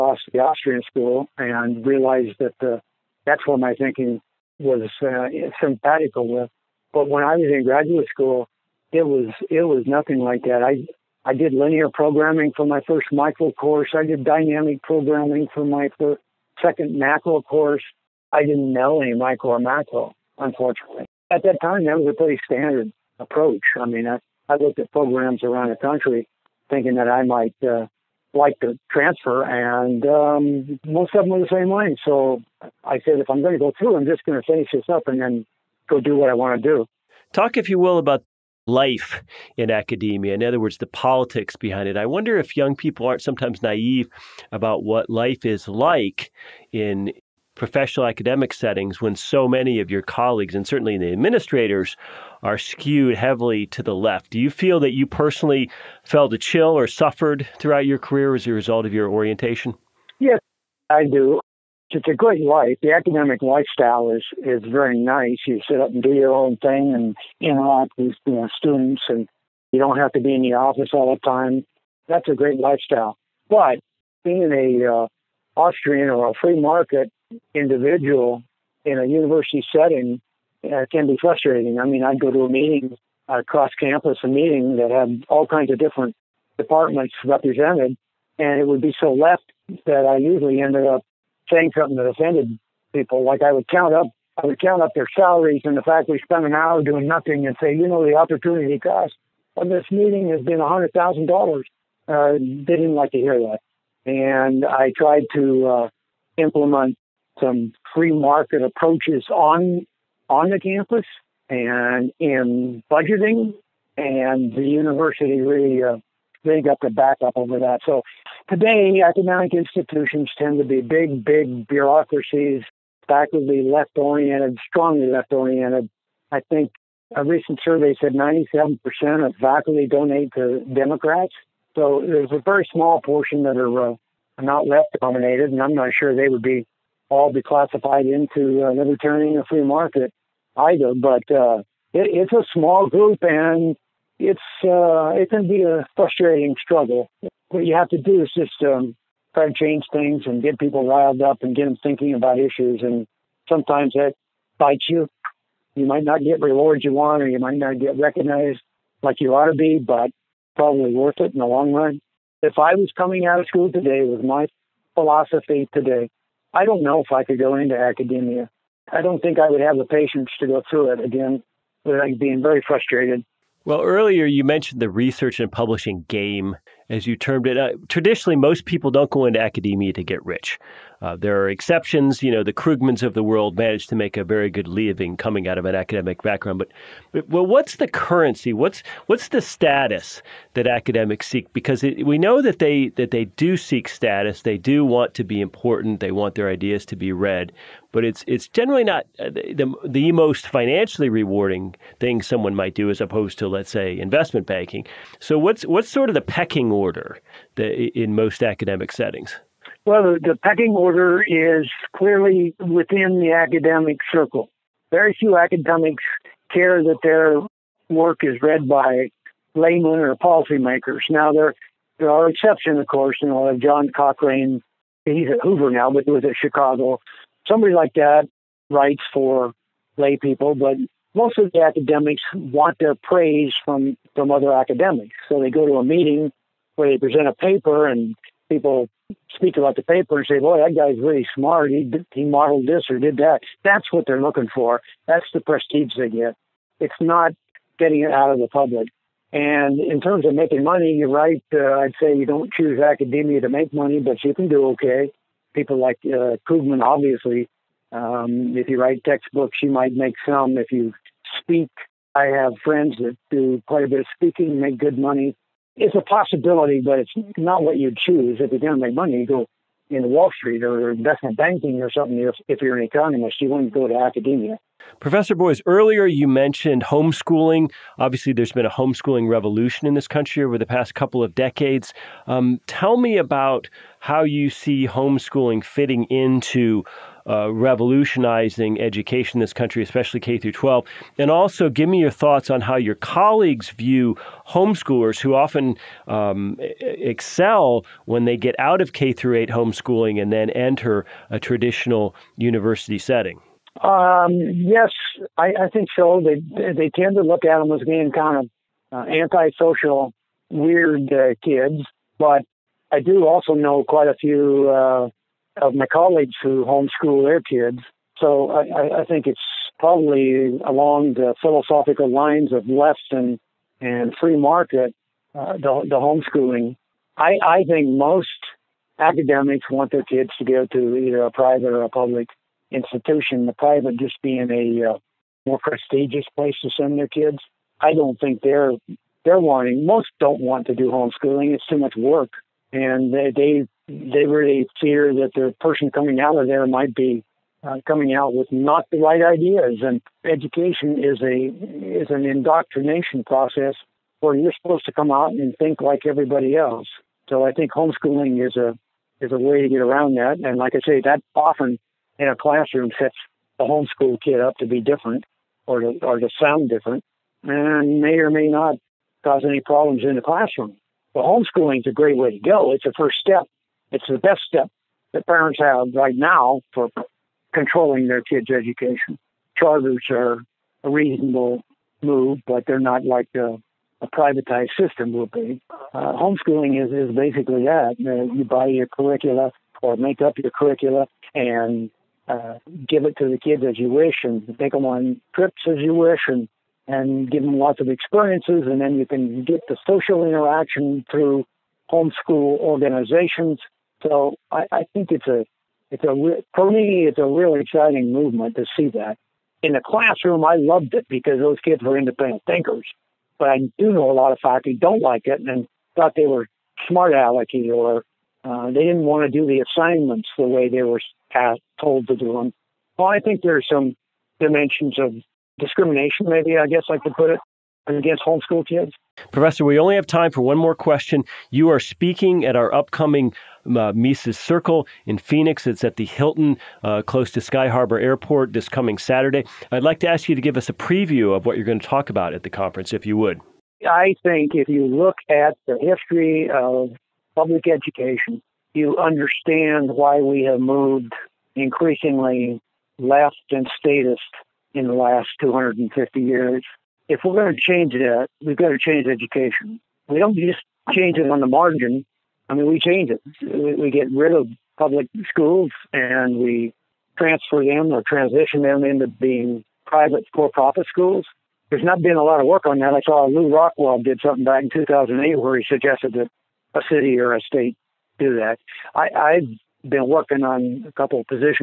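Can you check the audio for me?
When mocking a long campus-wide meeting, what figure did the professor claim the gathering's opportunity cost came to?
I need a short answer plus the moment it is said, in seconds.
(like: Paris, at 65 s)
$100,000, at 100 s.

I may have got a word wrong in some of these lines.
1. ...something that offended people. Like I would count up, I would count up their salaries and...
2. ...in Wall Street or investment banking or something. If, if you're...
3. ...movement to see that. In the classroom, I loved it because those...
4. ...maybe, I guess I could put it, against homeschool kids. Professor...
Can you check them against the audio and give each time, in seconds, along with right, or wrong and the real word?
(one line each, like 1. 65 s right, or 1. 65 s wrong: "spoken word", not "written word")
1. 91 s right
2. 269 s right
3. 408 s right
4. 426 s right.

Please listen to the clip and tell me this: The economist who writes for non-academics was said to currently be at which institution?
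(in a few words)
Hoover.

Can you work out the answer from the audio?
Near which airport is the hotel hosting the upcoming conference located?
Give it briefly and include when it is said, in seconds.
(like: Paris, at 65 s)
Sky Harbor Airport, at 437 s.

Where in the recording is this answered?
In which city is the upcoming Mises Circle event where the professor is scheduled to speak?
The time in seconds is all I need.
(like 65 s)
435 s.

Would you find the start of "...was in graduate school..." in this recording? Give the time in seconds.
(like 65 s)
7 s.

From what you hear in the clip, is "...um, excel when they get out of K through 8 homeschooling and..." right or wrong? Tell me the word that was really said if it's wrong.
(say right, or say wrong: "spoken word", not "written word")
right.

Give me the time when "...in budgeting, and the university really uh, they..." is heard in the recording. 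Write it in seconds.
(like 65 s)
112 s.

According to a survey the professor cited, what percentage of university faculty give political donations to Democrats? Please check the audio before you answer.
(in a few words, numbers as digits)
97%.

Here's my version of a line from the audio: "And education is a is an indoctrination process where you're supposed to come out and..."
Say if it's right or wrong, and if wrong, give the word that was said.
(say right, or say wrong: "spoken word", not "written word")
right.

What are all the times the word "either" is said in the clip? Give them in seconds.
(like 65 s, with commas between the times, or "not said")
140 s, 330 s.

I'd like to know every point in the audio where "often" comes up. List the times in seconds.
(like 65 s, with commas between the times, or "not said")
295 s, 361 s.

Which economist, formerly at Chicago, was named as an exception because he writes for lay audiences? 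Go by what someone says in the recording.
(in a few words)
John Cochrane.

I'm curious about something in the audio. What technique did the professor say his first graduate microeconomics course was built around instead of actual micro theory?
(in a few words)
Linear programming.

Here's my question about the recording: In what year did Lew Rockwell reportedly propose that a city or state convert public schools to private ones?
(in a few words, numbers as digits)
2008.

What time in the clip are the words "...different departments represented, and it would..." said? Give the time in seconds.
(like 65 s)
85 s.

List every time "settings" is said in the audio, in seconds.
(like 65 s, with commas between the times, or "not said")
48 s, 79 s, 208 s, 302 s.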